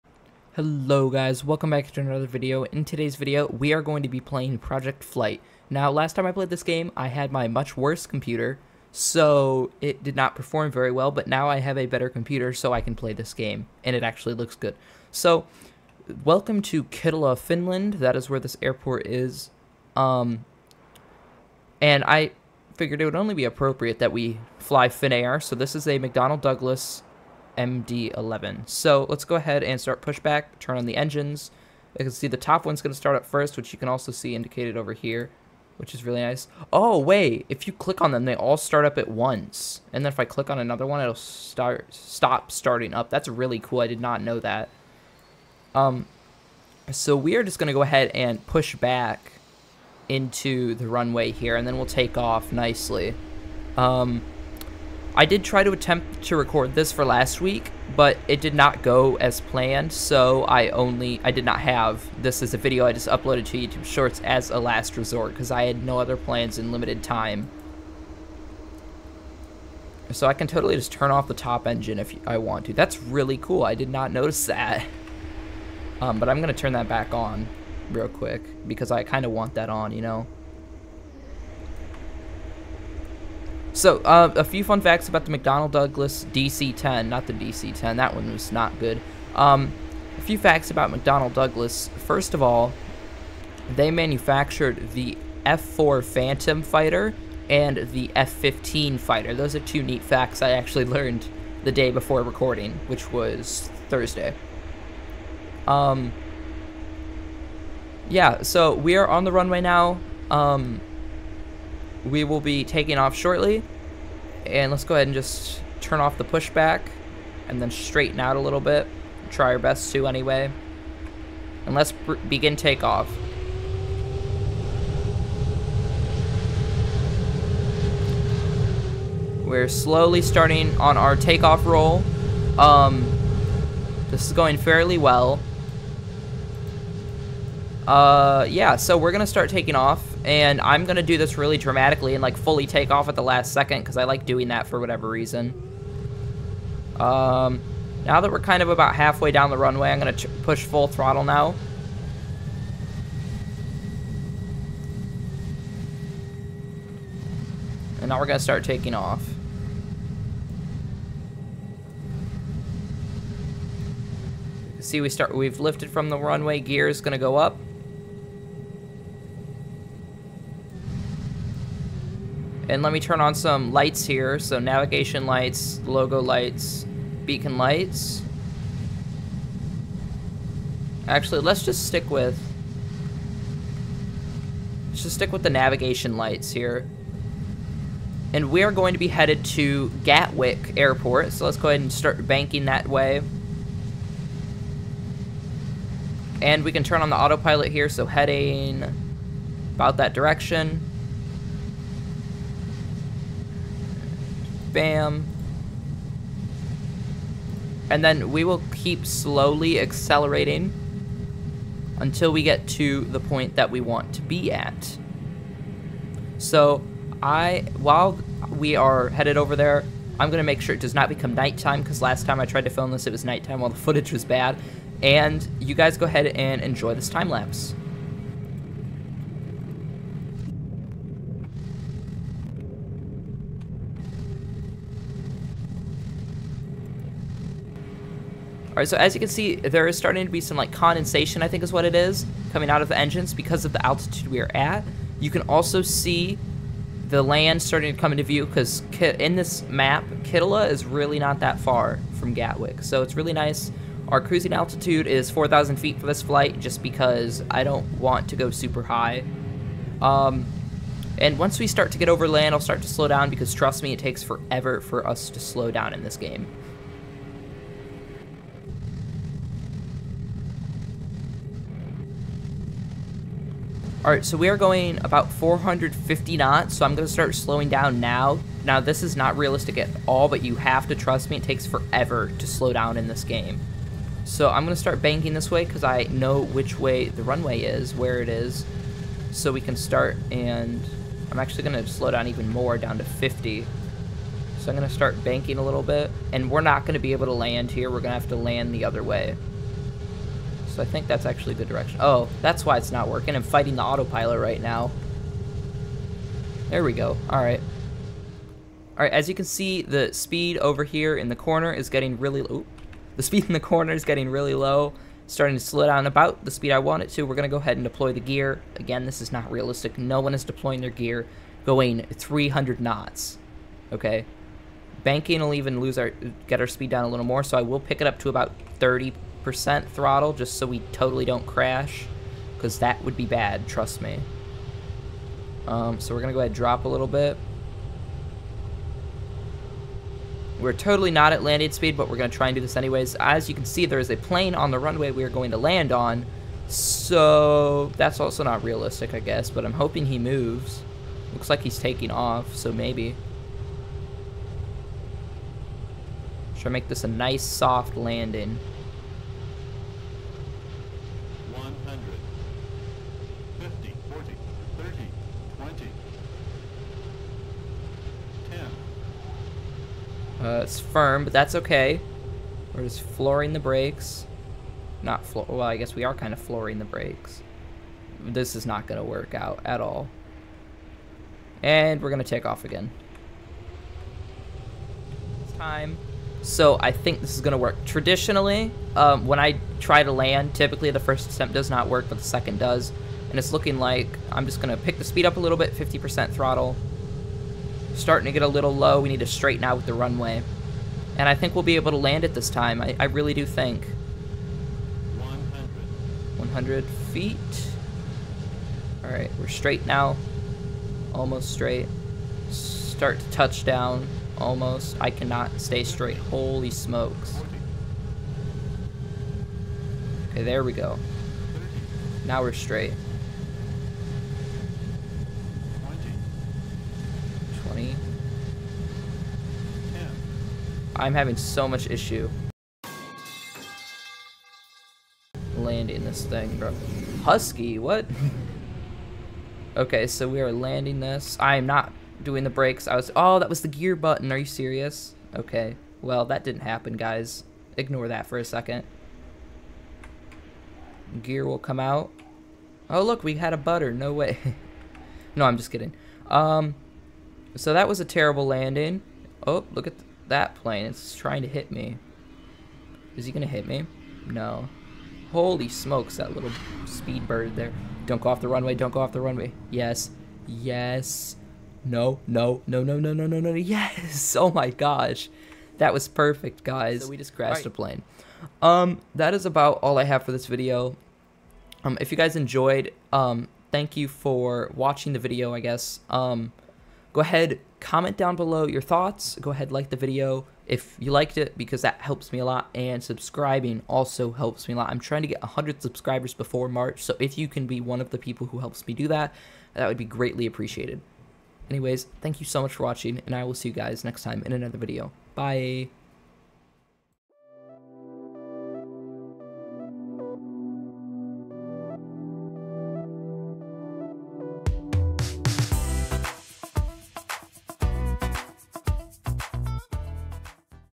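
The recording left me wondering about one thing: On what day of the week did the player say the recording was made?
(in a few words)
Thursday.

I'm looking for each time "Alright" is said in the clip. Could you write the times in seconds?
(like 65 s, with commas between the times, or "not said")
238 s, 274 s.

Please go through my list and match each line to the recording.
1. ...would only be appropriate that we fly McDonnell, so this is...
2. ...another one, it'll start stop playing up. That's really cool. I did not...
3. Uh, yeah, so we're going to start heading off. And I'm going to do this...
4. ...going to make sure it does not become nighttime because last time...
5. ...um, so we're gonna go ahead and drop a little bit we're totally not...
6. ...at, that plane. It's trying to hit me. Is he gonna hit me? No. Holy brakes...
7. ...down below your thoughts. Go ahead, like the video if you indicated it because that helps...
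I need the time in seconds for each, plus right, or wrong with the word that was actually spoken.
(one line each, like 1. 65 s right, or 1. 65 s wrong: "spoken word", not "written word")
1. 23 s wrong: "Finnair", not "McDonnell"
2. 40 s wrong: "starting", not "playing"
3. 137 s wrong: "taking", not "heading"
4. 220 s right
5. 335 s right
6. 459 s wrong: "smokes", not "brakes"
7. 488 s wrong: "liked", not "indicated".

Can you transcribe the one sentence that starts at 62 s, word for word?
I just uploaded to YouTube Shorts as a last resort because I had no other plans in limited time.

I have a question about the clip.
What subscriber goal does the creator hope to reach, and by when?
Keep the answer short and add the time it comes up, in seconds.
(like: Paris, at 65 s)
100 by March, at 495 s.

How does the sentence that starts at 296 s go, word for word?
And we're not going to be able to land here.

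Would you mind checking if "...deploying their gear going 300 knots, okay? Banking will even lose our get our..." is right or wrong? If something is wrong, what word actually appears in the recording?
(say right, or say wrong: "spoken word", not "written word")
right.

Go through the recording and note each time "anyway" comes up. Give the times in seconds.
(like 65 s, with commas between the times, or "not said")
120 s, 342 s, 501 s.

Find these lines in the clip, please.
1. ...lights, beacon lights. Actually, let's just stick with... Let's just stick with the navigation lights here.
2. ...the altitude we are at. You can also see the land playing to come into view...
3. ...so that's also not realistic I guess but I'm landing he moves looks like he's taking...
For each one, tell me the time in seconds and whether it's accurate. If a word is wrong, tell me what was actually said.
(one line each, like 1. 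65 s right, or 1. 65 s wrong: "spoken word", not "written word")
1. 176 s right
2. 243 s wrong: "starting", not "playing"
3. 346 s wrong: "hoping", not "landing".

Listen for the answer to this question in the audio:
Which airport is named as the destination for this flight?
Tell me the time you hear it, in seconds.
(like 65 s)
190 s.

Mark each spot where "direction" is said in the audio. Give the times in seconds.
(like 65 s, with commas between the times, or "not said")
200 s, 301 s.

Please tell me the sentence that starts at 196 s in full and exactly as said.
And we can turn on the autopilot here.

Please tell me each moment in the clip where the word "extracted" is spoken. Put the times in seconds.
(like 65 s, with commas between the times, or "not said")
not said.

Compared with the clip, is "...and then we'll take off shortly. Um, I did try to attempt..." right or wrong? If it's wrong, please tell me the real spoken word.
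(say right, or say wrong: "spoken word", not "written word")
wrong: "nicely", not "shortly".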